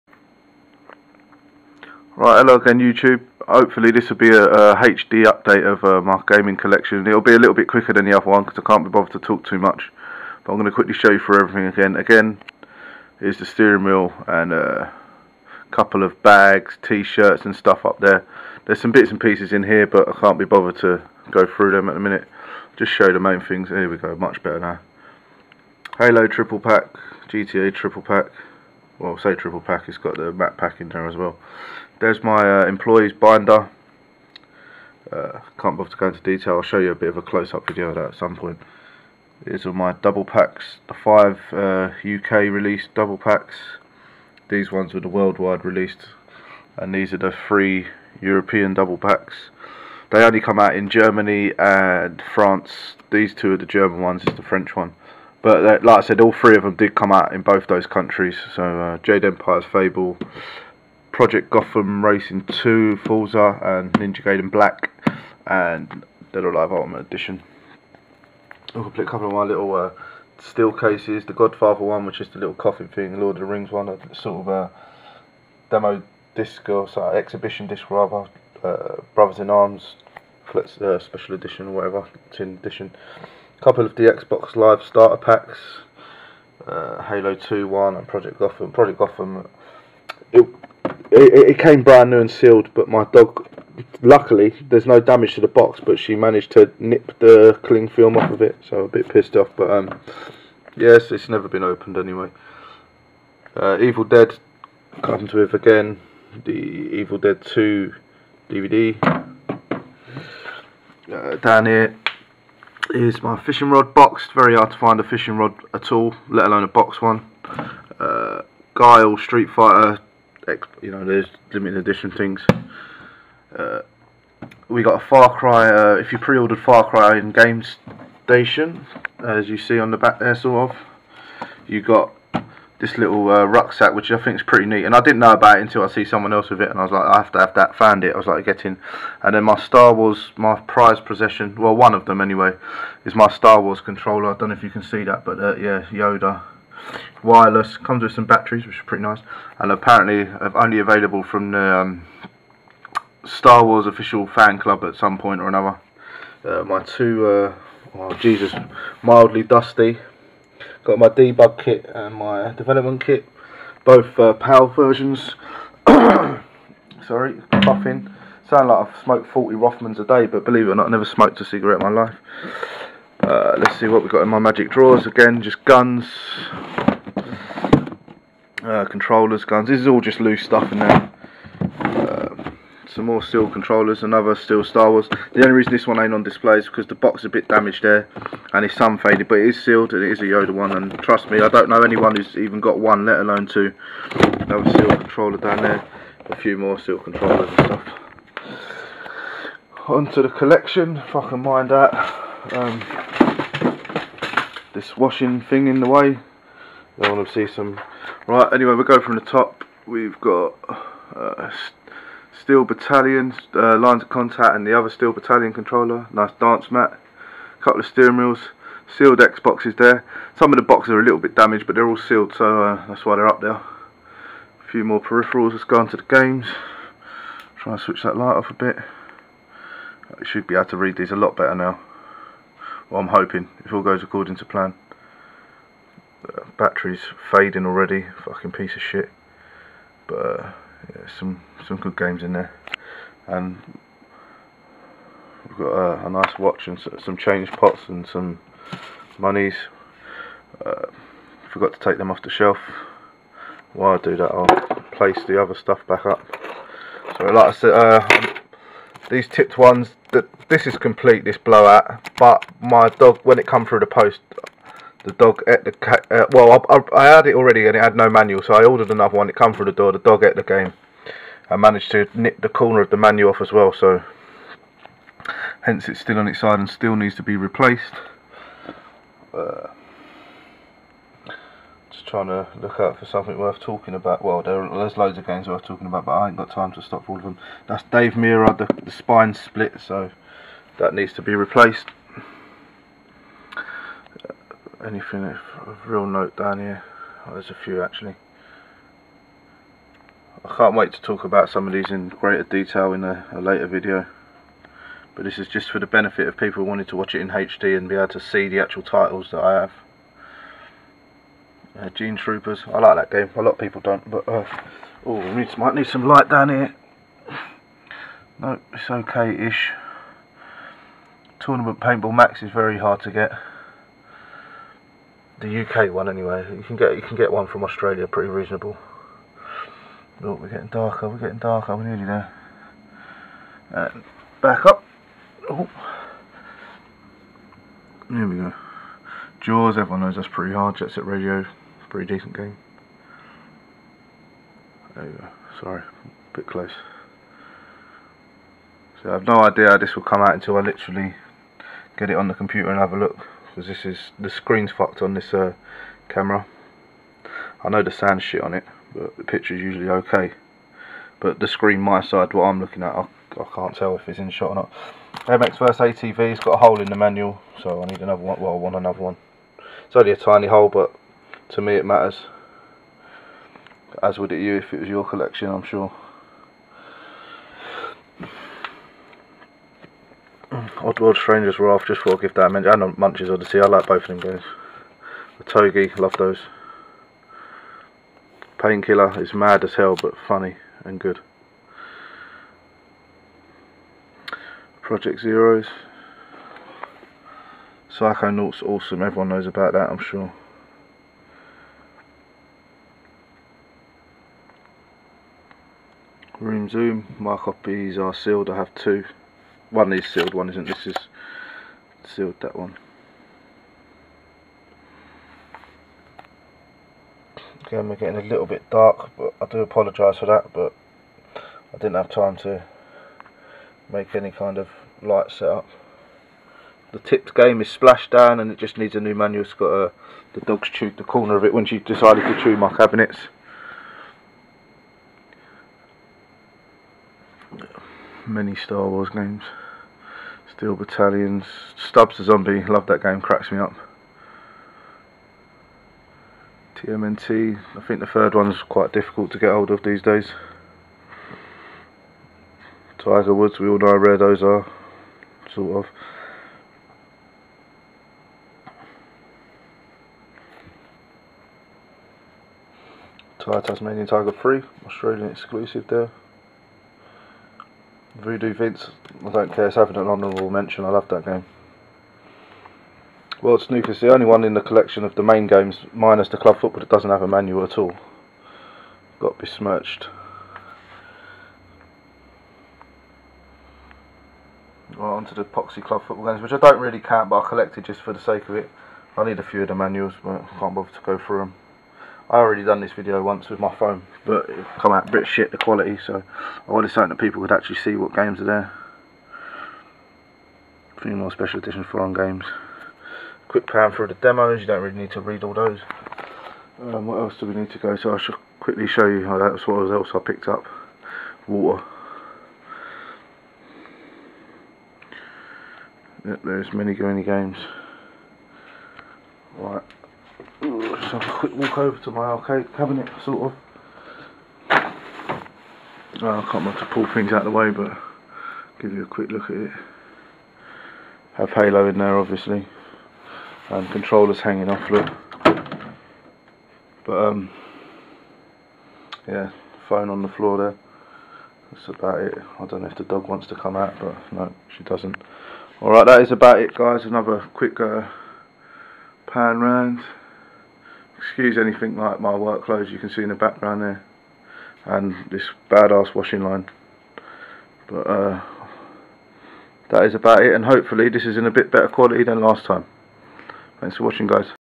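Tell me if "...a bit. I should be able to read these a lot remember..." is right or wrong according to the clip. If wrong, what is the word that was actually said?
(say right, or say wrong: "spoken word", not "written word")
wrong: "better", not "remember".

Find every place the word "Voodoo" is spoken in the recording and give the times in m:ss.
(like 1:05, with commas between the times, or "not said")
7:48.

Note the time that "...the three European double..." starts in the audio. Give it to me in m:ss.
0:47.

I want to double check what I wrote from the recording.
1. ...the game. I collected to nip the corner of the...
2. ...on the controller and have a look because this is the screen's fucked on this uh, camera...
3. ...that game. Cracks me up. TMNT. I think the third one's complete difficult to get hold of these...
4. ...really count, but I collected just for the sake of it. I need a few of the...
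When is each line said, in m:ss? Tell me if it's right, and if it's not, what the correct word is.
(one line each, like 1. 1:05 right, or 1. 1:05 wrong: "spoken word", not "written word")
1. 4:30 wrong: "managed", not "collected"
2. 5:52 wrong: "computer", not "controller"
3. 7:22 wrong: "quite", not "complete"
4. 8:06 right.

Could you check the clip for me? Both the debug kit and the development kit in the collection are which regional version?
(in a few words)
PAL.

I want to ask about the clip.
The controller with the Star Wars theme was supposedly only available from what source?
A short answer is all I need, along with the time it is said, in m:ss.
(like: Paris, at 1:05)
Star Wars official fan club, at 2:33.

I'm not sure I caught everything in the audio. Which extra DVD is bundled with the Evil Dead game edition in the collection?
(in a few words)
Evil Dead 2.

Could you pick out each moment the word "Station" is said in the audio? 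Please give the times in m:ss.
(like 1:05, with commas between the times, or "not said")
2:08.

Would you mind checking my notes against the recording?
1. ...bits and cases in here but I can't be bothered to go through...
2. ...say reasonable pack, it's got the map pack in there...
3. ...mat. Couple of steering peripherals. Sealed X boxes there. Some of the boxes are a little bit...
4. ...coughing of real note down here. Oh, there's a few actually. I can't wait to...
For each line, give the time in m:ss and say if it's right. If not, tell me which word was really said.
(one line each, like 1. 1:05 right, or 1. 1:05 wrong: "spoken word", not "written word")
1. 0:18 wrong: "pieces", not "cases"
2. 0:29 wrong: "triple", not "reasonable"
3. 3:36 wrong: "wheels", not "peripherals"
4. 4:54 wrong: "anything", not "coughing".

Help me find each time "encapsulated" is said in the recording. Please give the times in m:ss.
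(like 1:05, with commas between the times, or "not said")
not said.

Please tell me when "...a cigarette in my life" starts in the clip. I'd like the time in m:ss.
2:51.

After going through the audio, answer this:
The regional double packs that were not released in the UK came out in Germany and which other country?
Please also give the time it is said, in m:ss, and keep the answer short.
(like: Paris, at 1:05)
France, at 0:52.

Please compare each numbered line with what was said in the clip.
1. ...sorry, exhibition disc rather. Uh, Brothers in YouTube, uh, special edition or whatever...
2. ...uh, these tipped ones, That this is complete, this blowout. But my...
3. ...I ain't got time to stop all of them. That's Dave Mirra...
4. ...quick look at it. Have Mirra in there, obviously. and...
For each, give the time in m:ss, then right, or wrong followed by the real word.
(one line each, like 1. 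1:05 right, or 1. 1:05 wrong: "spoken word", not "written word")
1. 1:16 wrong: "Arms", not "YouTube"
2. 4:17 right
3. 4:46 right
4. 8:49 wrong: "Halo", not "Mirra".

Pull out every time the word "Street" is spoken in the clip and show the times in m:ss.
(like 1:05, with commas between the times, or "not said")
1:59.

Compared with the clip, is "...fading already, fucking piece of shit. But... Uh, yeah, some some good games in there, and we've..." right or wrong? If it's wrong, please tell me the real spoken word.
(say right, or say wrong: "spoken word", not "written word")
right.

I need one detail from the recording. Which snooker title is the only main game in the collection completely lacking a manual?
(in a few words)
World Snooker.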